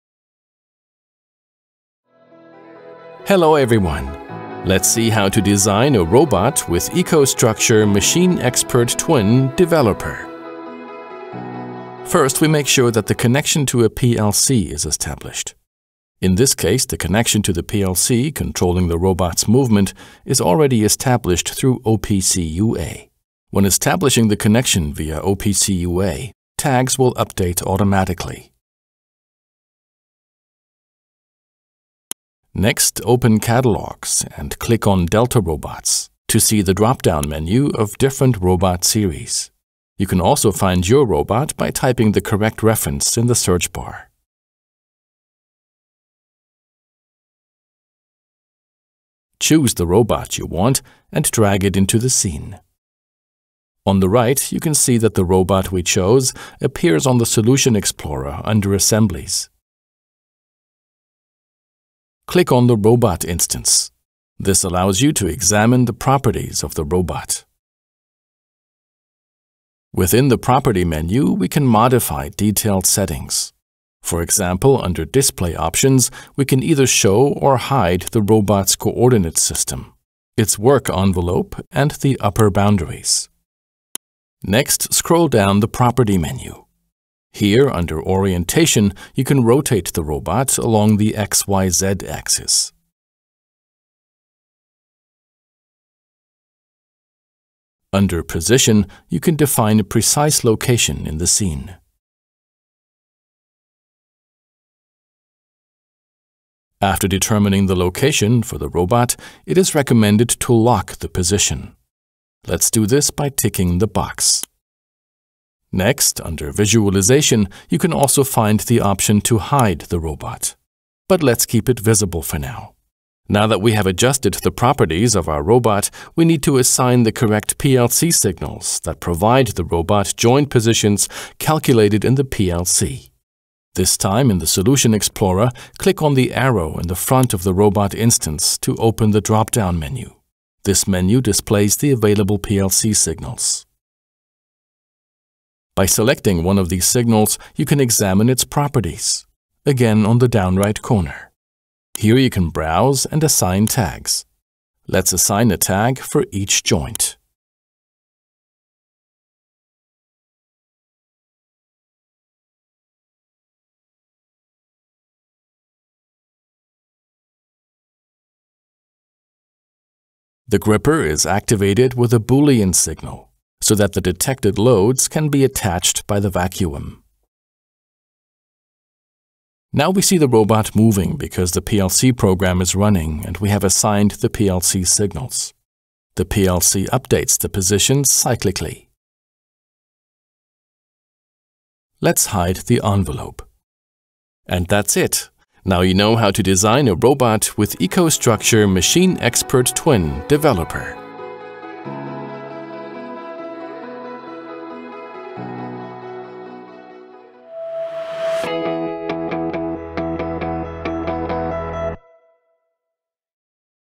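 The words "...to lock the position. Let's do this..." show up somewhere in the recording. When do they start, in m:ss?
1:50.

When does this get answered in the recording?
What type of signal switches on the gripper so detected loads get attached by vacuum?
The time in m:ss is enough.
2:52.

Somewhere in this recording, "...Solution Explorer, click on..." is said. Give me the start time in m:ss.
2:14.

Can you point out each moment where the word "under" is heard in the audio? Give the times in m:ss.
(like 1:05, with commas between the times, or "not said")
0:58, 1:14, 1:27, 1:37, 1:56.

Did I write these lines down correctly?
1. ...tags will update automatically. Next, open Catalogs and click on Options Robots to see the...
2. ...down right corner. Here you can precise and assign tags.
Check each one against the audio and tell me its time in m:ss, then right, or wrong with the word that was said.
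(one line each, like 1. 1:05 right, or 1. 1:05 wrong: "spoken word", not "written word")
1. 0:26 wrong: "Delta", not "Options"
2. 2:30 wrong: "browse", not "precise".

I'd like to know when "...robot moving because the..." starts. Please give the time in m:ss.
3:00.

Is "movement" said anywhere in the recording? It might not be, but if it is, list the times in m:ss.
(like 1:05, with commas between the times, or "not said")
0:19.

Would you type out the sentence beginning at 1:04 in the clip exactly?
This allows you to examine the properties of the robot.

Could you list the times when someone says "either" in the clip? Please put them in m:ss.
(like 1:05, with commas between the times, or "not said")
1:16.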